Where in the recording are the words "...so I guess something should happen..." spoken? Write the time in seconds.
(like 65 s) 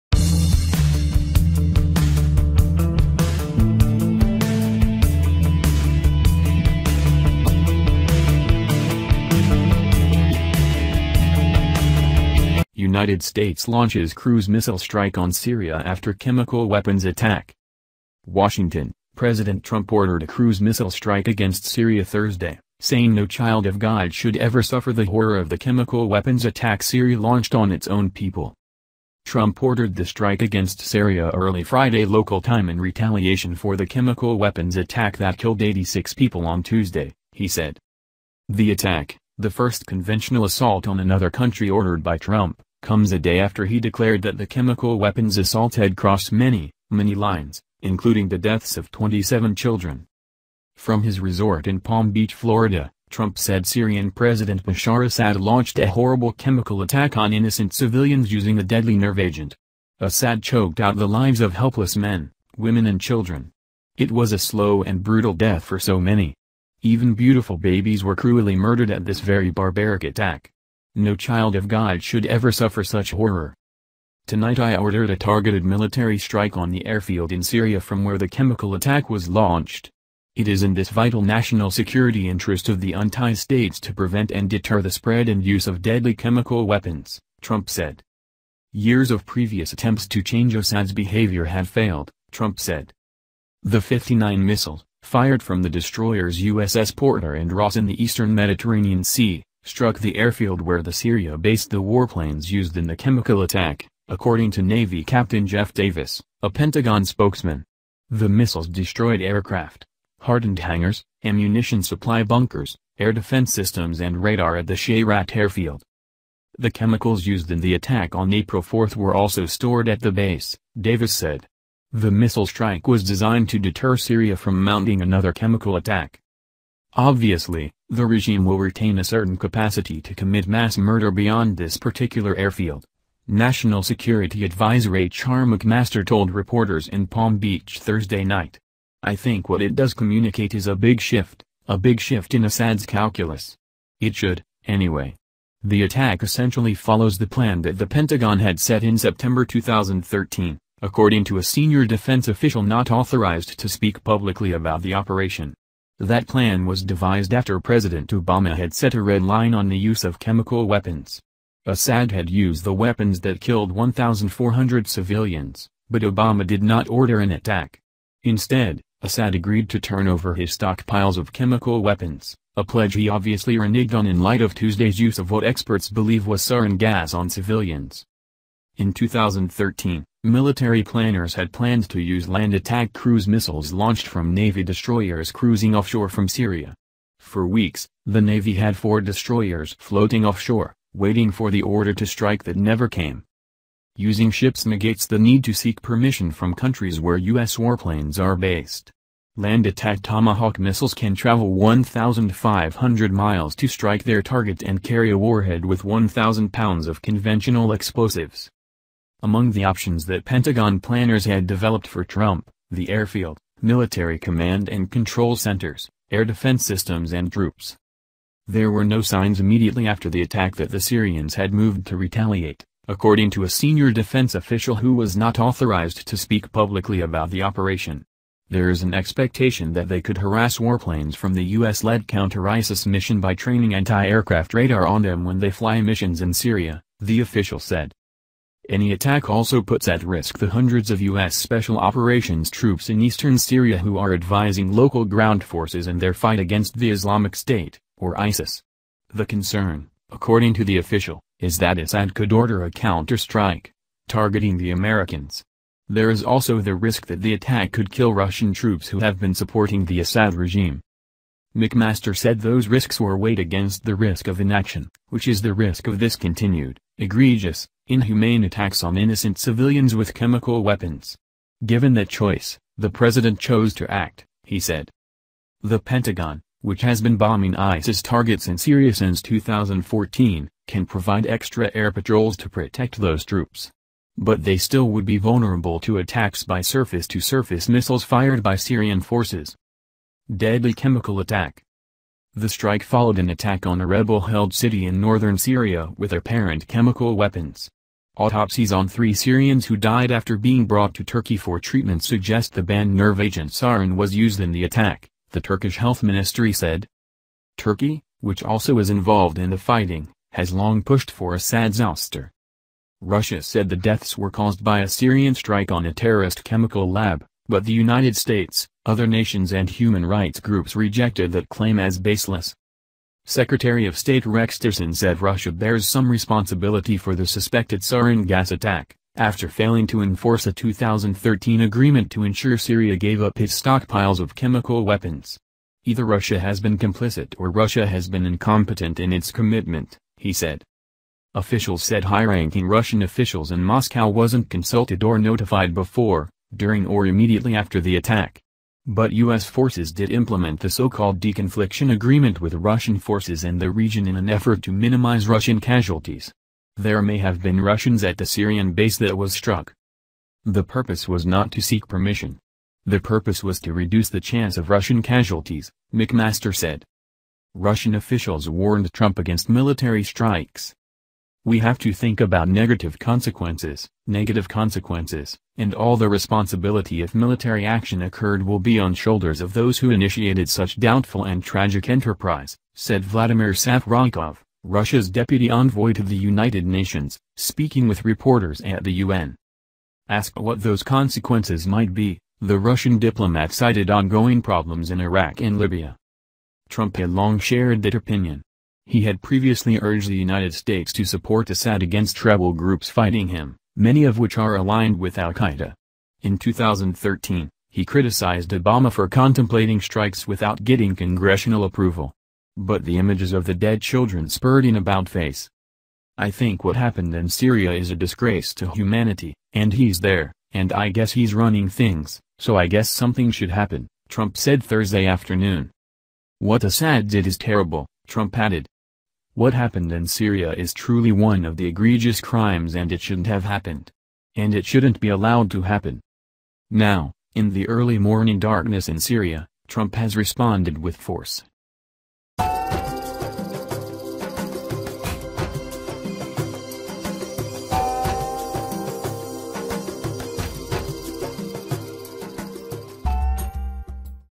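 422 s.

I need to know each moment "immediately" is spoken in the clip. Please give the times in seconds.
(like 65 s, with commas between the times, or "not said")
219 s, 347 s.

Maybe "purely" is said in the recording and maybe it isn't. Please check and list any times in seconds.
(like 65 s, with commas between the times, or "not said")
not said.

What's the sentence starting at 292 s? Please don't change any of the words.
The strike followed an attack on a rebel-held city in northern Syria with apparent chemical weapons.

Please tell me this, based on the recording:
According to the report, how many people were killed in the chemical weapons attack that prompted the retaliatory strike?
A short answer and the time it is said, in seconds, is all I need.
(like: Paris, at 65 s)
86, at 35 s.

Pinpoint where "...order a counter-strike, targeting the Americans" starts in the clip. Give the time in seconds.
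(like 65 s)
252 s.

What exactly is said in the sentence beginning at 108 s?
The missiles destroyed aircraft, hardened hangars, ammunition supply bunkers, air defense systems and radar at the Shayrat airfield.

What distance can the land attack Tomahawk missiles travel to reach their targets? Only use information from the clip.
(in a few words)
1,500 miles.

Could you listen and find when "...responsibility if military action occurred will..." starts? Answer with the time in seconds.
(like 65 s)
376 s.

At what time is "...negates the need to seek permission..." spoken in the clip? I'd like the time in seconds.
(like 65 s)
194 s.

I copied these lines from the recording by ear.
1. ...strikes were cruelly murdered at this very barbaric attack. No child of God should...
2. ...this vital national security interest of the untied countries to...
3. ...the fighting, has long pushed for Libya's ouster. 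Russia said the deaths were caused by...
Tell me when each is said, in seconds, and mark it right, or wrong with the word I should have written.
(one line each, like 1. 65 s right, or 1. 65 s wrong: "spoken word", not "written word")
1. 67 s wrong: "babies", not "strikes"
2. 80 s wrong: "states", not "countries"
3. 309 s wrong: "Assad", not "Libya".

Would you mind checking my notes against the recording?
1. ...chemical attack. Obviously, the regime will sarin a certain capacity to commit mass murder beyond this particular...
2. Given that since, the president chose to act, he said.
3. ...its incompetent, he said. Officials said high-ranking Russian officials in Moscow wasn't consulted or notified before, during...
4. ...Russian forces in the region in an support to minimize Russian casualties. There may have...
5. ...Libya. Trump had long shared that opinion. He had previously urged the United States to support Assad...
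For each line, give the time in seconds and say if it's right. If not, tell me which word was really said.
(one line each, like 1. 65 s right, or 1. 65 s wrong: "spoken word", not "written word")
1. 125 s wrong: "retain", not "sarin"
2. 271 s wrong: "choice", not "since"
3. 339 s wrong: "commitment", not "incompetent"
4. 352 s wrong: "effort", not "support"
5. 395 s right.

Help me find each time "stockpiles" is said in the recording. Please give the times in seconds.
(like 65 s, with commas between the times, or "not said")
170 s, 333 s.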